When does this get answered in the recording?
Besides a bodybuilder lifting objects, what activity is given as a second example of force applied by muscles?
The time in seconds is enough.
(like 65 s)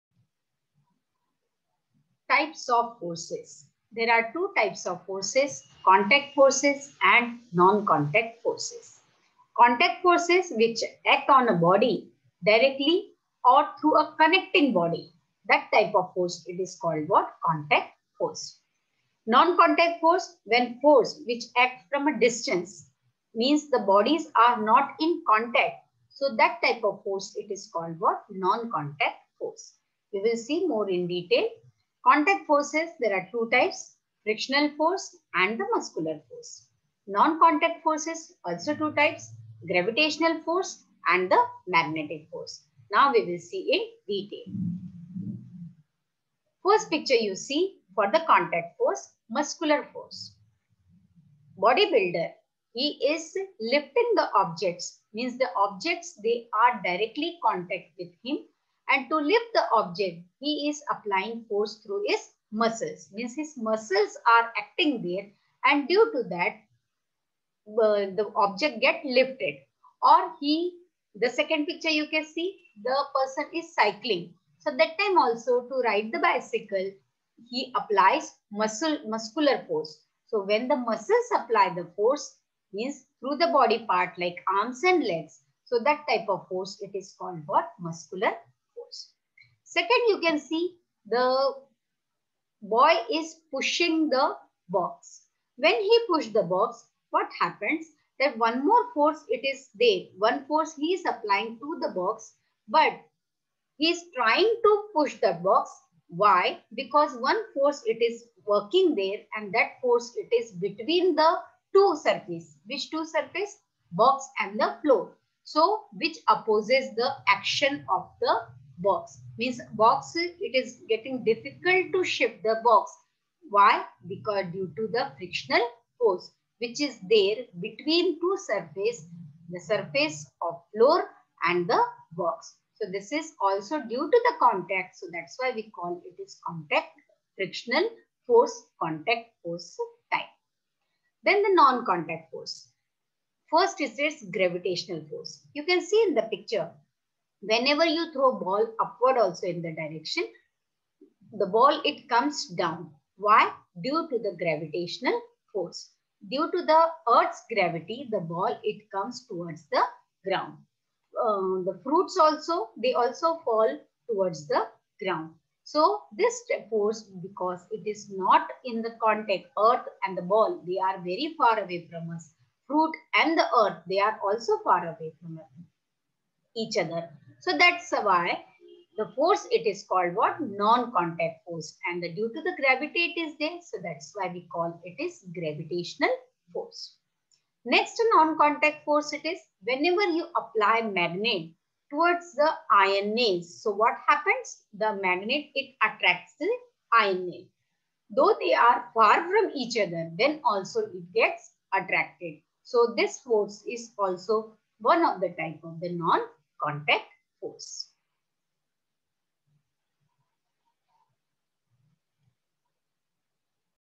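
73 s.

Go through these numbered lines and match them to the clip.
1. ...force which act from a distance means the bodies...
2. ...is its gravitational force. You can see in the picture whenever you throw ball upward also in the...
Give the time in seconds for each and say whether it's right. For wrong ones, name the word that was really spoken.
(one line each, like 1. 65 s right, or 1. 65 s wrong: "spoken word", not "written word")
1. 20 s right
2. 143 s right.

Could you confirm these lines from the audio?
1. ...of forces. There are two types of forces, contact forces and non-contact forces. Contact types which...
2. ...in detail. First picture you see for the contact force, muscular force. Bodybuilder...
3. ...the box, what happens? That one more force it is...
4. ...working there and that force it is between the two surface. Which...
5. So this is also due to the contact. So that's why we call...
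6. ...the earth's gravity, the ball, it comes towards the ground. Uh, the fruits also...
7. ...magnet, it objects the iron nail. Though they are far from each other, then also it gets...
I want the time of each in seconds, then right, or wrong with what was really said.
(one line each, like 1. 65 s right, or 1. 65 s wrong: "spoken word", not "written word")
1. 2 s wrong: "forces", not "types"
2. 43 s right
3. 96 s right
4. 108 s right
5. 132 s right
6. 156 s right
7. 195 s wrong: "attracts", not "objects".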